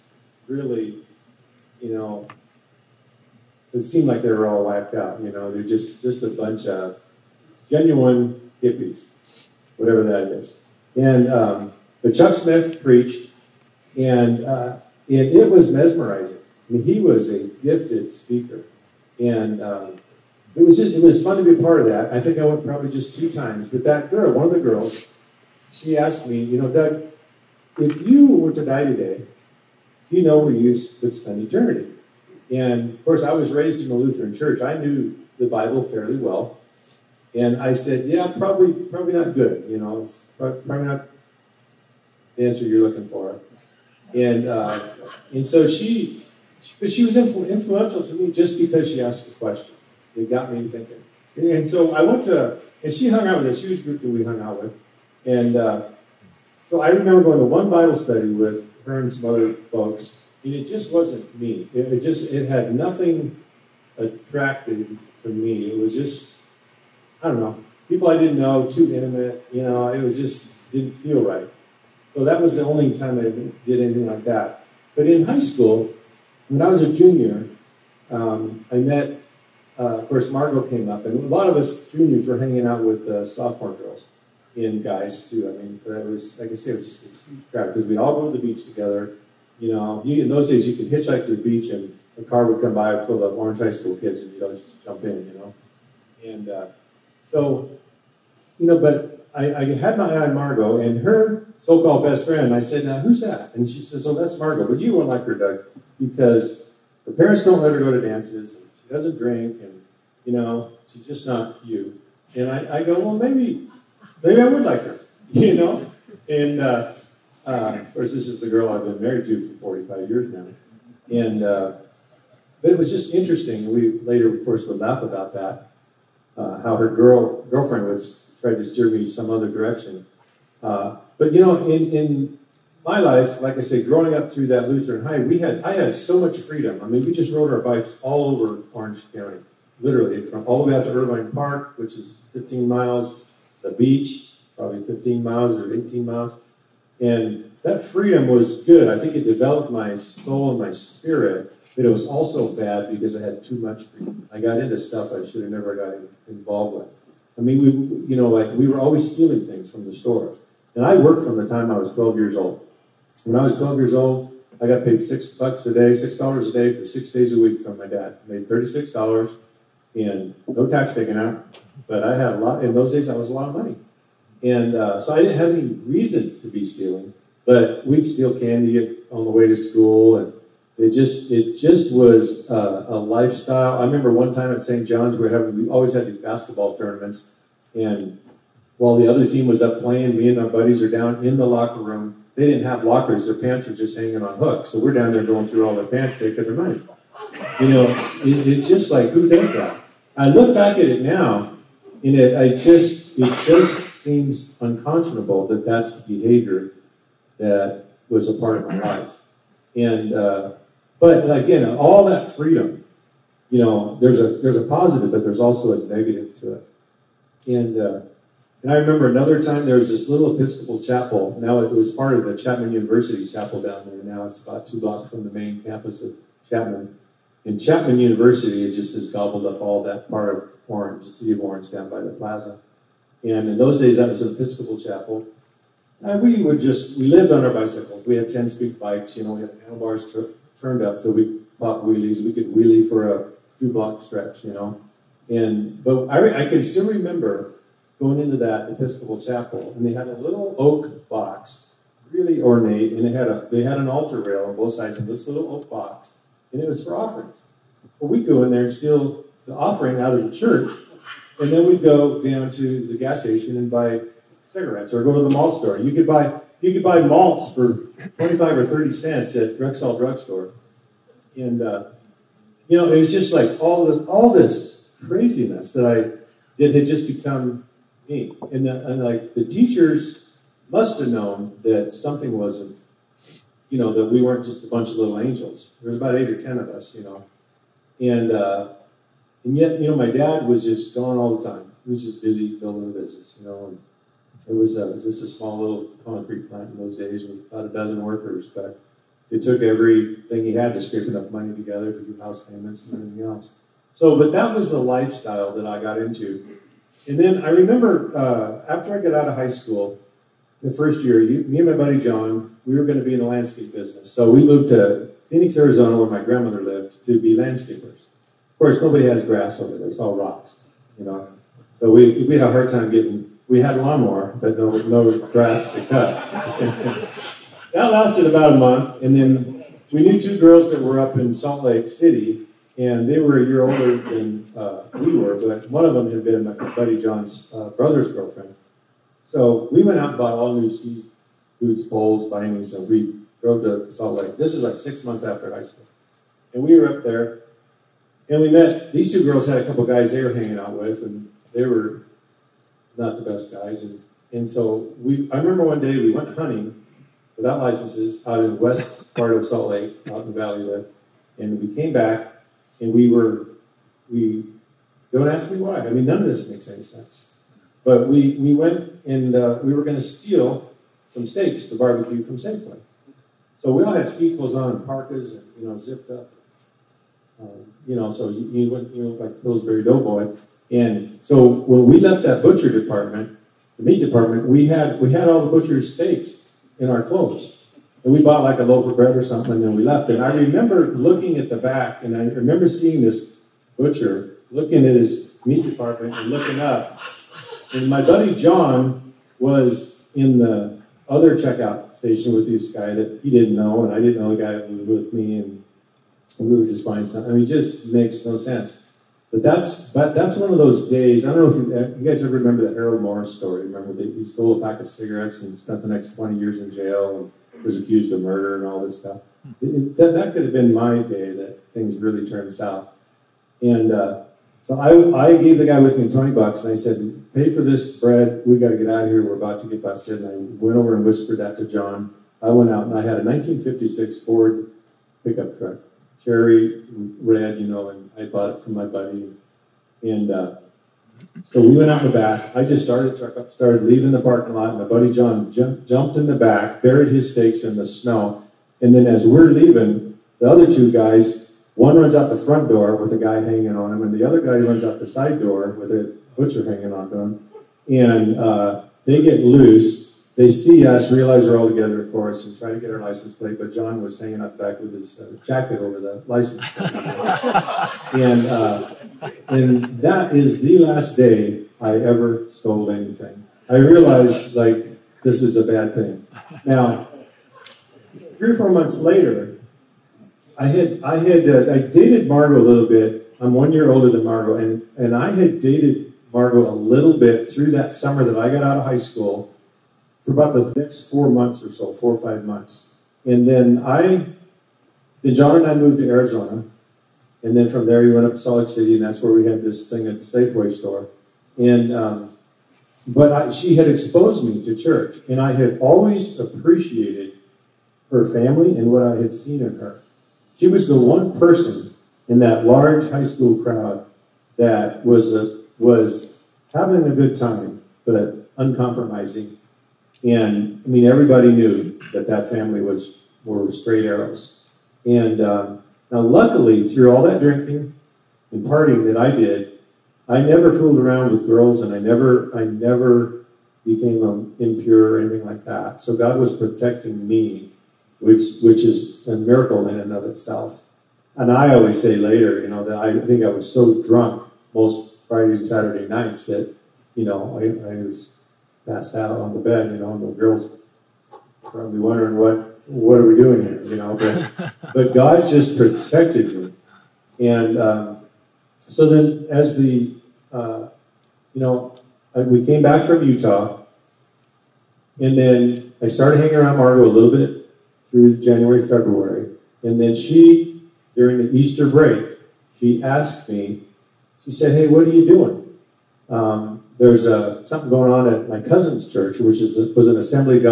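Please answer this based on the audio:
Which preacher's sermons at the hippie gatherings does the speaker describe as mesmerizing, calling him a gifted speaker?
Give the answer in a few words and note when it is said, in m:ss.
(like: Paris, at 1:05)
Chuck Smith, at 0:12.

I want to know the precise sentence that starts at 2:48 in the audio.
I made thirty-six dollars and no tax taken out, but I had a lot.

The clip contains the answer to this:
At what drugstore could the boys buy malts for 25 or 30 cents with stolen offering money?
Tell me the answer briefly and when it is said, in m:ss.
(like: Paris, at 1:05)
Rexall, at 4:29.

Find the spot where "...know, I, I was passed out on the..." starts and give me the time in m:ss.
9:07.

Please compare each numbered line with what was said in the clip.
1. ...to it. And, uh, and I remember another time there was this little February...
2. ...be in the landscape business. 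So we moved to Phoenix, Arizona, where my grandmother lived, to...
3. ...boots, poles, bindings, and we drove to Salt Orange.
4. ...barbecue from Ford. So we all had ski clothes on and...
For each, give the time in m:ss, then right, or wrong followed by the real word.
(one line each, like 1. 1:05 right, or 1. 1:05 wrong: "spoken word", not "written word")
1. 3:36 wrong: "Episcopal", not "February"
2. 5:13 right
3. 5:41 wrong: "Lake", not "Orange"
4. 6:11 wrong: "Safeway", not "Ford".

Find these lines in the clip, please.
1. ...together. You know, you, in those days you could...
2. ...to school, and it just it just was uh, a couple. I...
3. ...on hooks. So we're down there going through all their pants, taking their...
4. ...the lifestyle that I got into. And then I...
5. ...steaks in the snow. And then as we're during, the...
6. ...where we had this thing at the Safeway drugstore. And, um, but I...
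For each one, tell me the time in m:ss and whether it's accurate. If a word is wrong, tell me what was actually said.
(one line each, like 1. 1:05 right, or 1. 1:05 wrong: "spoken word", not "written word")
1. 1:28 right
2. 2:59 wrong: "lifestyle", not "couple"
3. 3:14 right
4. 5:04 right
5. 7:27 wrong: "leaving", not "during"
6. 8:19 wrong: "store", not "drugstore".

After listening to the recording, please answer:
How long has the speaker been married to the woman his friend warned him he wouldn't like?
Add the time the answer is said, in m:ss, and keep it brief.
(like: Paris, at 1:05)
45 years, at 1:59.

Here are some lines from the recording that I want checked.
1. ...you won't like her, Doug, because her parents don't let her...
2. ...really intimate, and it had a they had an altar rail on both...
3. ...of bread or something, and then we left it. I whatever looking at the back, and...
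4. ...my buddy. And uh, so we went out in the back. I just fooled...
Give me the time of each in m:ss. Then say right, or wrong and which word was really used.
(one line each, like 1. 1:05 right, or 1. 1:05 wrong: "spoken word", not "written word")
1. 1:44 right
2. 4:12 wrong: "ornate", not "intimate"
3. 6:28 wrong: "remember", not "whatever"
4. 7:18 wrong: "started", not "fooled".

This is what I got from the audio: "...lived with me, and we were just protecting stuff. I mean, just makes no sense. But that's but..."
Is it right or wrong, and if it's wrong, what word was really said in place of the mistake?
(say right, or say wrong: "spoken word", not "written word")
wrong: "buying", not "protecting".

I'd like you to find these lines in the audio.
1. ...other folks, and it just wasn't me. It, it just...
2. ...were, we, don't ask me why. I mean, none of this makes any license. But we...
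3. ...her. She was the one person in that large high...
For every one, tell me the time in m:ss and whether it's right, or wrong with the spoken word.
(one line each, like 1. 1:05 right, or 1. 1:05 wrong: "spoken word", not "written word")
1. 0:59 right
2. 6:03 wrong: "sense", not "license"
3. 8:29 right.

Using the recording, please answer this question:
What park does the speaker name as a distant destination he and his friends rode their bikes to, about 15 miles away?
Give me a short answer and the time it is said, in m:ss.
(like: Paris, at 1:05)
Irvine Park, at 2:20.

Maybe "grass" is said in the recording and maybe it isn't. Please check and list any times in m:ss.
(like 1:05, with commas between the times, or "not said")
5:19, 5:25.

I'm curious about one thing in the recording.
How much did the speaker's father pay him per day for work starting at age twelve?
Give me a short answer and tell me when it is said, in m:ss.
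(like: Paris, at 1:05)
$6, at 2:45.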